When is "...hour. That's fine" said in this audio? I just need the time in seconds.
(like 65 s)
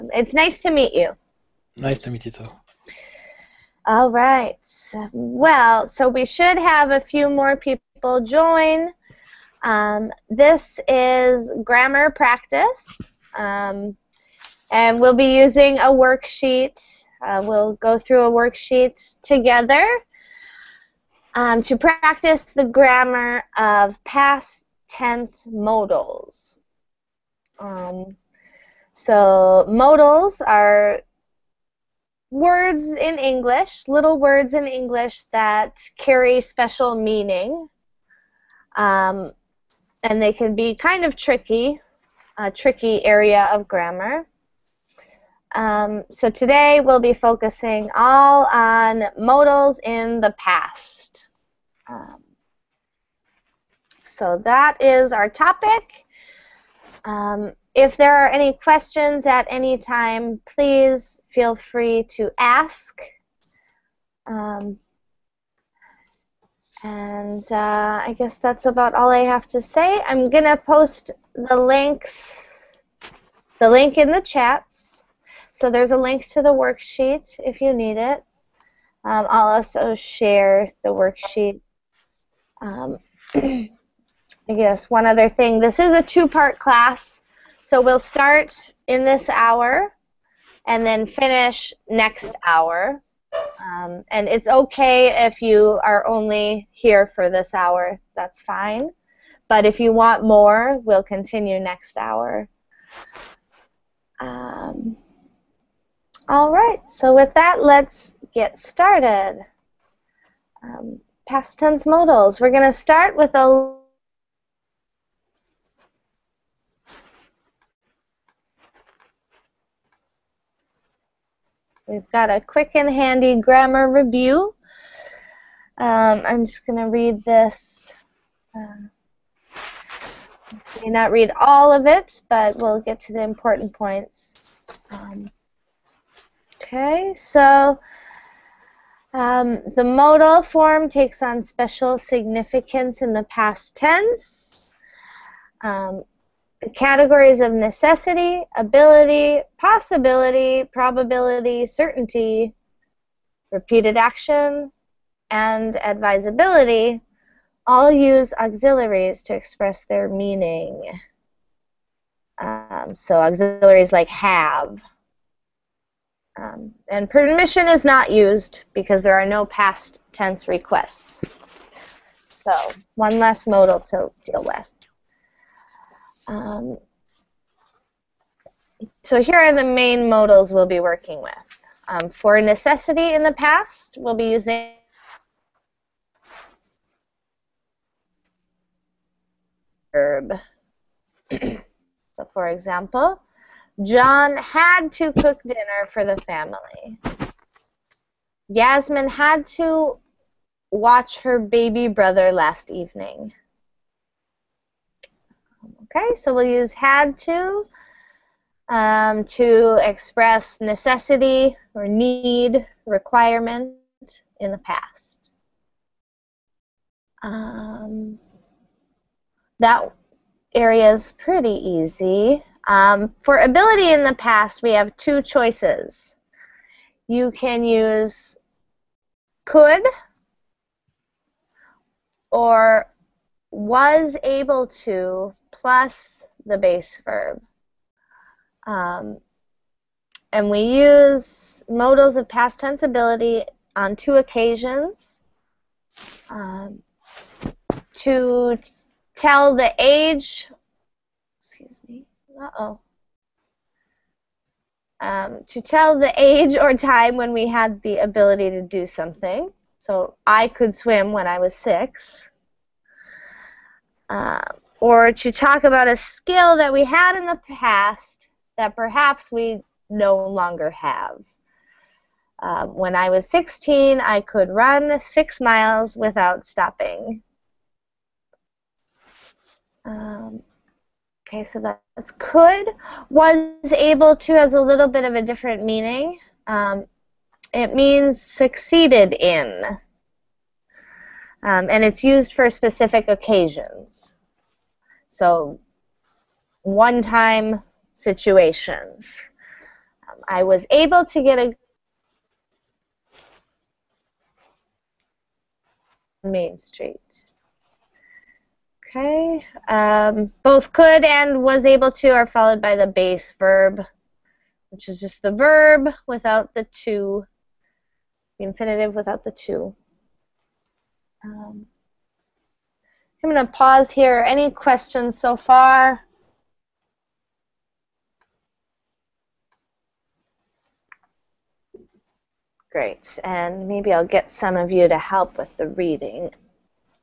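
97 s.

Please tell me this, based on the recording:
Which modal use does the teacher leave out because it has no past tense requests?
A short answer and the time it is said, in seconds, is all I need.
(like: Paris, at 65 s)
permission, at 167 s.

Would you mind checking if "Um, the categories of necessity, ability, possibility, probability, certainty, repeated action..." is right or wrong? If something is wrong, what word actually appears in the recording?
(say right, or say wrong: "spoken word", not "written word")
right.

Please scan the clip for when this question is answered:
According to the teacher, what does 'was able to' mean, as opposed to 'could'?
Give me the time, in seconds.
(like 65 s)
288 s.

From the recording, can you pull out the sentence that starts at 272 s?
Uh, when I was 16, I could run six miles without stopping.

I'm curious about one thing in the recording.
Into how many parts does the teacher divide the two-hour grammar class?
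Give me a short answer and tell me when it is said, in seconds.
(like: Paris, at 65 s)
2, at 86 s.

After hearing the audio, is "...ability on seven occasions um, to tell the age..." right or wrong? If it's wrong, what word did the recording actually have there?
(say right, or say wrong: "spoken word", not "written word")
wrong: "two", not "seven".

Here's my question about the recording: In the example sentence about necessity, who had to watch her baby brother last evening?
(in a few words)
Yasmin.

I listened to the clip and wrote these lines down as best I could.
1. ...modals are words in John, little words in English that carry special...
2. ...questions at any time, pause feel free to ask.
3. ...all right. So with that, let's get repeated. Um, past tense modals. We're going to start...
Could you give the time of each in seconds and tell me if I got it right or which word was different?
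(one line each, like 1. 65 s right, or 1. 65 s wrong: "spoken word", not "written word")
1. 29 s wrong: "English", not "John"
2. 58 s wrong: "please", not "pause"
3. 106 s wrong: "started", not "repeated".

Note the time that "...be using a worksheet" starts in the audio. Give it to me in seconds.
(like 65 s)
15 s.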